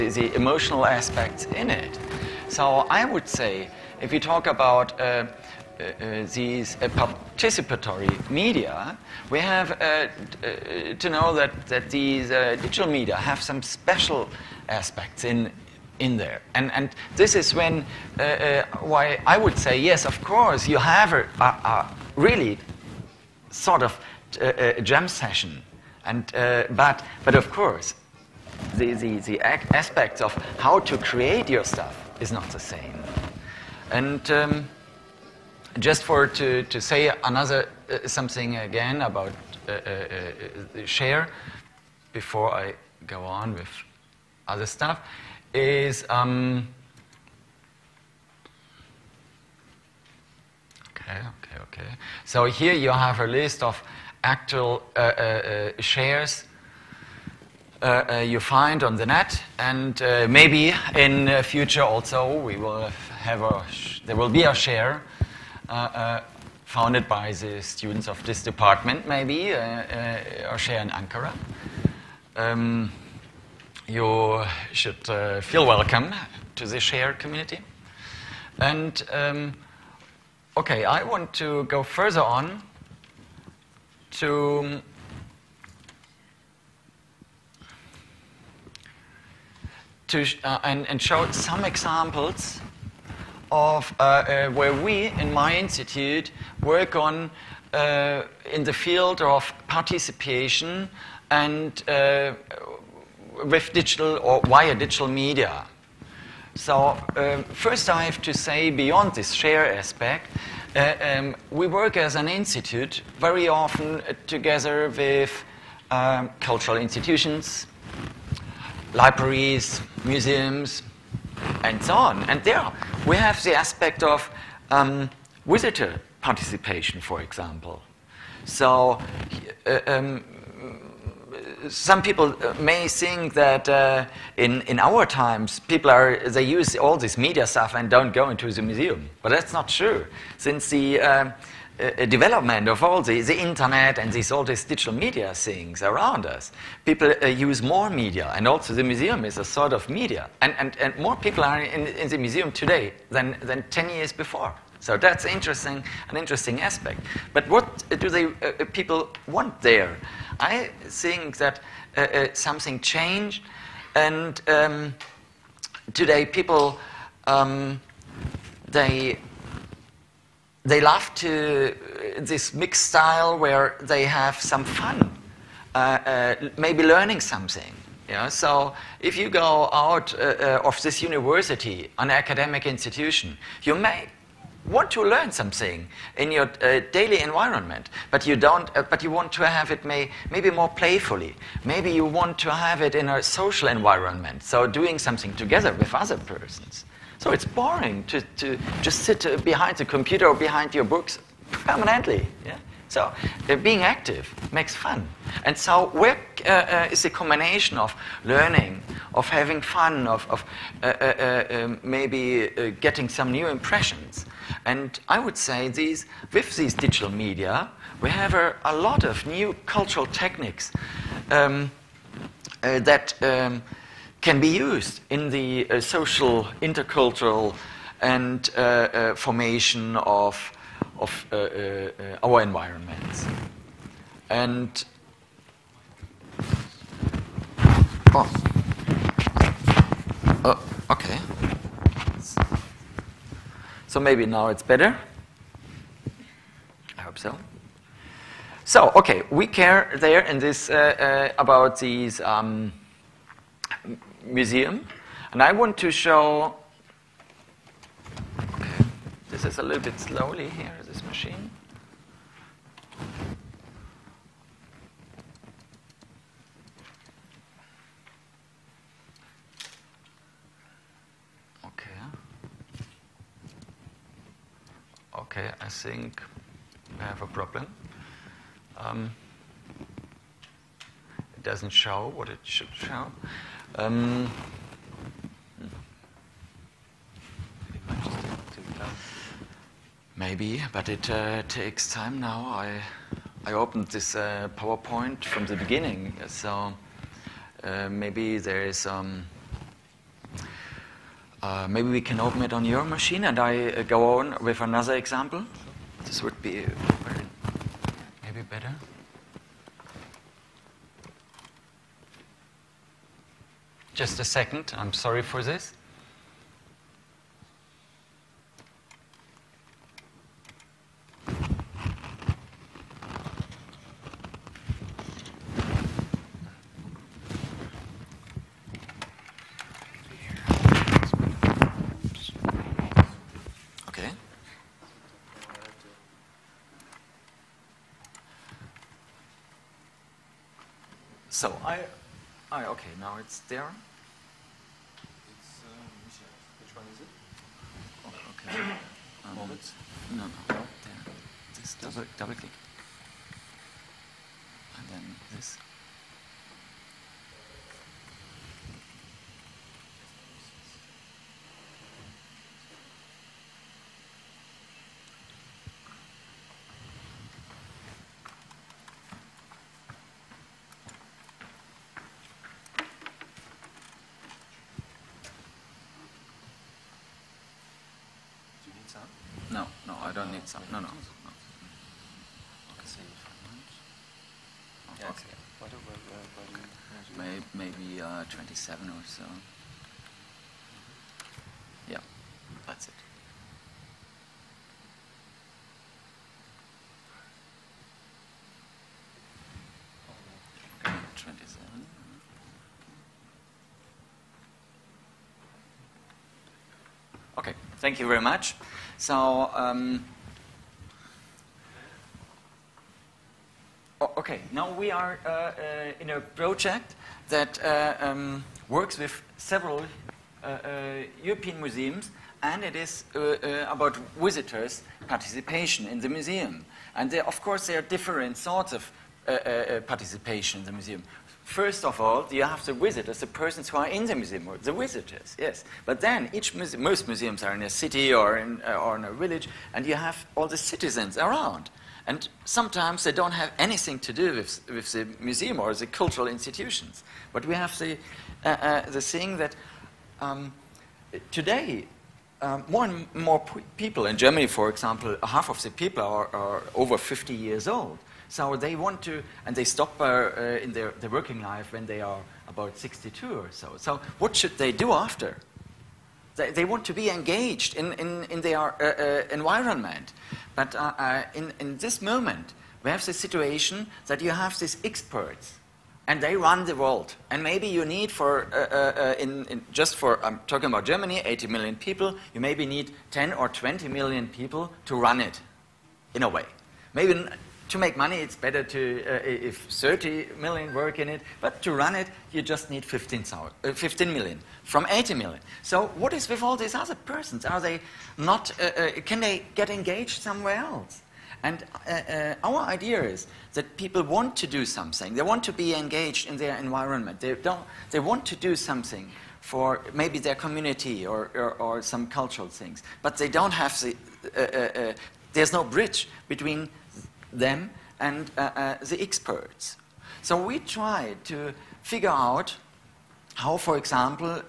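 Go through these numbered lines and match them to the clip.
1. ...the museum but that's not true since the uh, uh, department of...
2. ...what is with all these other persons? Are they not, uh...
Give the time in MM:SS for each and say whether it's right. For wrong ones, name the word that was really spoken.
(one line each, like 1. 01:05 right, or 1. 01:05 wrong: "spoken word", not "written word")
1. 02:18 wrong: "development", not "department"
2. 08:15 right.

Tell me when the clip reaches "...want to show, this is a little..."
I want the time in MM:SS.
04:15.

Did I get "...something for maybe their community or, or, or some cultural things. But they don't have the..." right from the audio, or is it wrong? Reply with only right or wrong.
right.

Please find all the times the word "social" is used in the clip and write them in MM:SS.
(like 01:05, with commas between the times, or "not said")
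03:13, 03:45.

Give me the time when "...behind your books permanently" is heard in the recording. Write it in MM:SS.
03:20.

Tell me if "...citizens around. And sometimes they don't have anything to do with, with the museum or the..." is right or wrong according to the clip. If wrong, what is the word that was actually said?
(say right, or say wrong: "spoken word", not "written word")
right.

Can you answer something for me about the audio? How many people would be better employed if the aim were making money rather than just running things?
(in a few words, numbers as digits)
30 million.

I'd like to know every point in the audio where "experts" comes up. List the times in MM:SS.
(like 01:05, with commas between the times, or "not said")
07:54, 08:39.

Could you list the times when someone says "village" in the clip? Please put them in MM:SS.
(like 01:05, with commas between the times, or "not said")
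07:19.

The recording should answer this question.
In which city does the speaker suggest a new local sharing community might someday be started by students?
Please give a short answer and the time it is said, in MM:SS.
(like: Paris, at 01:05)
Ankara, at 01:10.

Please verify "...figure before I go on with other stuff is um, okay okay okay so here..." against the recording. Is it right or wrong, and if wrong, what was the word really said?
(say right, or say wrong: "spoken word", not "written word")
wrong: "share", not "figure".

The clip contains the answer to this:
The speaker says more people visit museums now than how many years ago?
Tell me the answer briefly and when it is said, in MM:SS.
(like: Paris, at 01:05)
10 years, at 02:33.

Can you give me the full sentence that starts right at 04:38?
Um, it doesn't show what it should show.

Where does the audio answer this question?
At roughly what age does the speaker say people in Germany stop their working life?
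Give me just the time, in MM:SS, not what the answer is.
07:42.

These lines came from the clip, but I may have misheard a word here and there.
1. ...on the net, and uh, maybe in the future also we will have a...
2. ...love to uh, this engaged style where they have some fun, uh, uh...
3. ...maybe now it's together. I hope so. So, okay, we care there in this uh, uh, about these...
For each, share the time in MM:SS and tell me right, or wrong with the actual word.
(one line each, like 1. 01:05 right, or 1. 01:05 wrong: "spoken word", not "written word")
1. 00:58 right
2. 02:50 wrong: "mixed", not "engaged"
3. 04:03 wrong: "better", not "together".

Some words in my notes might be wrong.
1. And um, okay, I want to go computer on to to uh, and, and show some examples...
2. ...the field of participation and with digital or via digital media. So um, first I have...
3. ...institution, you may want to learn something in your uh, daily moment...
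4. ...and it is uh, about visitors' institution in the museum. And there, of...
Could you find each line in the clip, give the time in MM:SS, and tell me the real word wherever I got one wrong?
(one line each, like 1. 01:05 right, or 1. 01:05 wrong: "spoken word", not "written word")
1. 01:18 wrong: "further", not "computer"
2. 01:38 right
3. 03:02 wrong: "environment", not "moment"
4. 07:02 wrong: "participation", not "institution".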